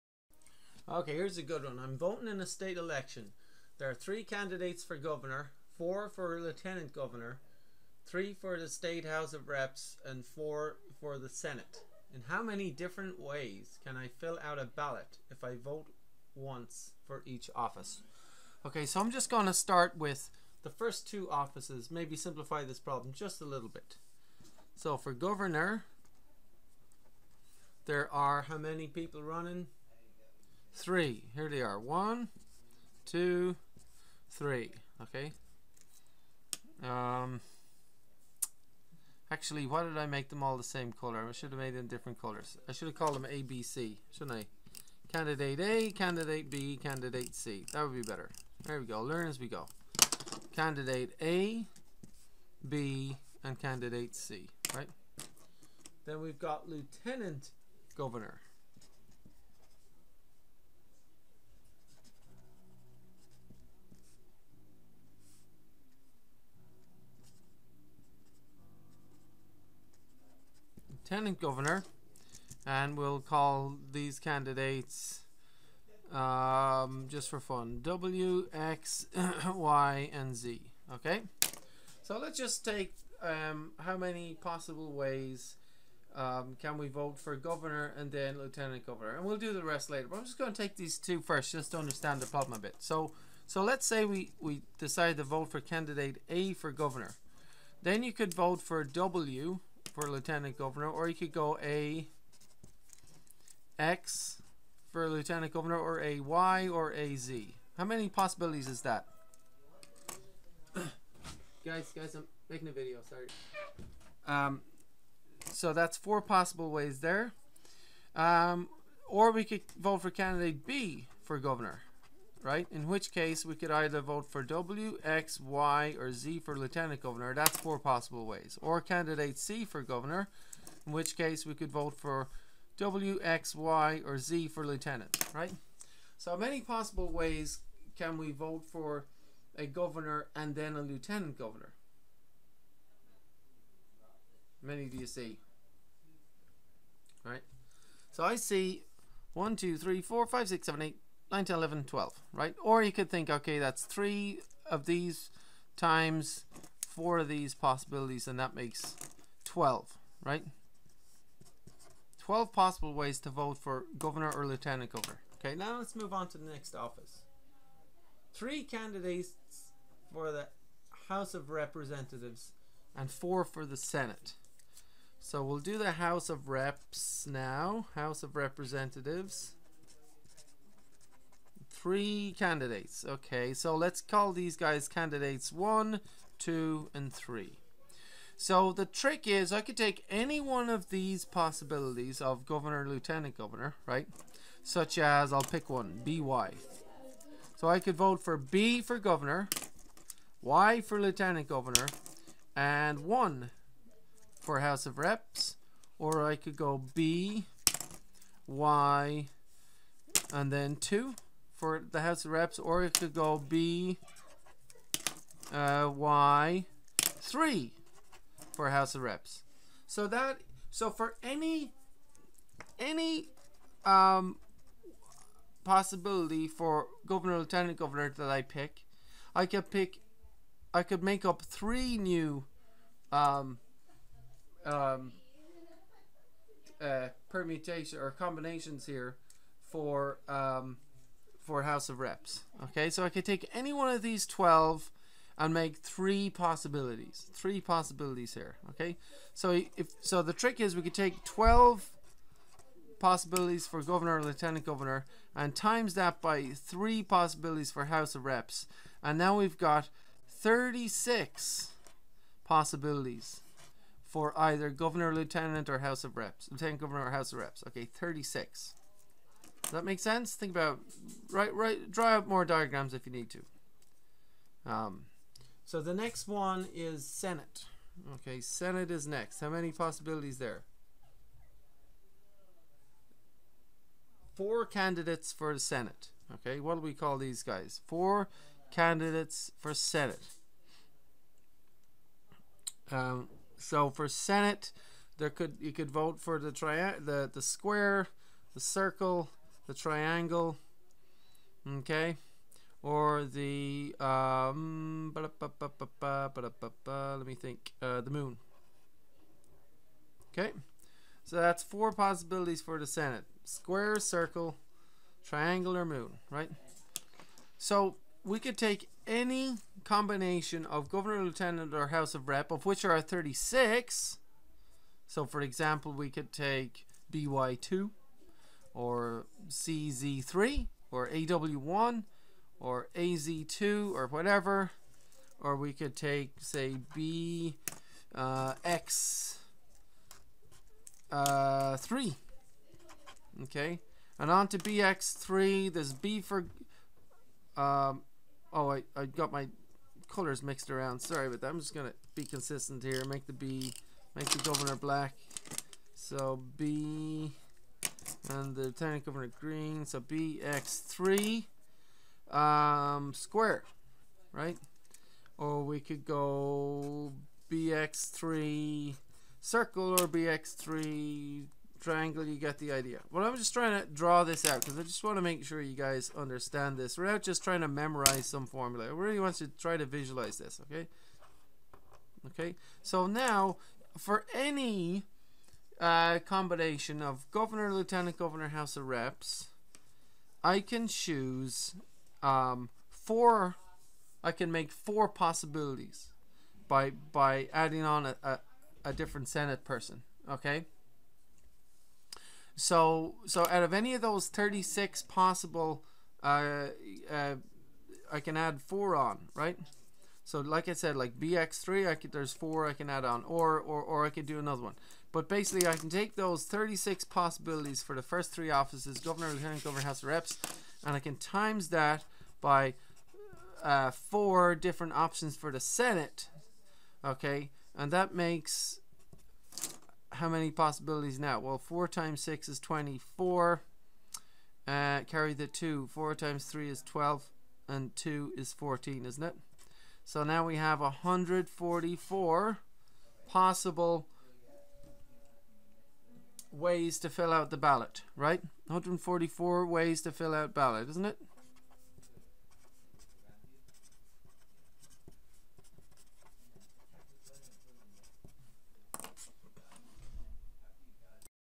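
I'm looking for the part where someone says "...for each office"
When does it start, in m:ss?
0:17.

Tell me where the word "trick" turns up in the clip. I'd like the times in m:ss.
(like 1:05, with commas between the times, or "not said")
3:08, 4:10.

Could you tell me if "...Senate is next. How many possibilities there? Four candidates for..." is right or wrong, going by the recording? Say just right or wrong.
right.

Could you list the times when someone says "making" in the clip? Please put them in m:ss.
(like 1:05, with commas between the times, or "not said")
1:52.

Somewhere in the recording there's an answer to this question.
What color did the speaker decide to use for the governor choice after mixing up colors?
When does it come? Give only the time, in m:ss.
5:54.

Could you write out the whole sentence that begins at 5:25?
So, for example, we could take BY2 or CZ3 or AW1 or AZ2 or whatever.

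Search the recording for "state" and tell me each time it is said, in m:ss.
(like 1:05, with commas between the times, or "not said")
0:02, 0:08.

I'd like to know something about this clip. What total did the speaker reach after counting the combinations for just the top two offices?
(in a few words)
12.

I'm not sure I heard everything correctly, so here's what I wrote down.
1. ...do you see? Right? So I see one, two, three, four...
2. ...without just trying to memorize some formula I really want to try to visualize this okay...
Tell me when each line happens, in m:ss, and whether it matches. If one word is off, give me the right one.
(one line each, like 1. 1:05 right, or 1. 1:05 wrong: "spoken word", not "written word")
1. 2:24 right
2. 6:16 right.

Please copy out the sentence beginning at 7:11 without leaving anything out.
Well, 4 times 6 is 24.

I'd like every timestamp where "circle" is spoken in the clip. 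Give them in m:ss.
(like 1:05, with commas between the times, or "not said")
4:58, 5:13, 6:09.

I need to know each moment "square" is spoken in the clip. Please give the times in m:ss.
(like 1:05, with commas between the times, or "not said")
4:57, 5:13, 6:03.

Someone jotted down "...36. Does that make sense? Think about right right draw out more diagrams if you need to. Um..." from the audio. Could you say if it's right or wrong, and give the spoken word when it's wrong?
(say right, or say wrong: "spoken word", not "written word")
right.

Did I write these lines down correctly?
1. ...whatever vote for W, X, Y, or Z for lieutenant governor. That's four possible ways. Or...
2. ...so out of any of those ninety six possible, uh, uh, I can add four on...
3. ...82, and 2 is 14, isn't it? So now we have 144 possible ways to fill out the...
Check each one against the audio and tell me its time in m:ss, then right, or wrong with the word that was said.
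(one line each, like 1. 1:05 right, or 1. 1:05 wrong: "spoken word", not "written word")
1. 2:03 wrong: "either", not "whatever"
2. 6:43 wrong: "thirty", not "ninety"
3. 7:16 wrong: "12", not "82".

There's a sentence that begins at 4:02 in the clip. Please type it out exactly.
Okay, so I could take any one of these 12 and make three possibilities.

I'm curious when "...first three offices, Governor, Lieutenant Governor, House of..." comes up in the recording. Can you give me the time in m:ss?
6:58.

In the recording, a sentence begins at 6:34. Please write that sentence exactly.
I can make four possibilities by by adding on a, a, a different Senate person.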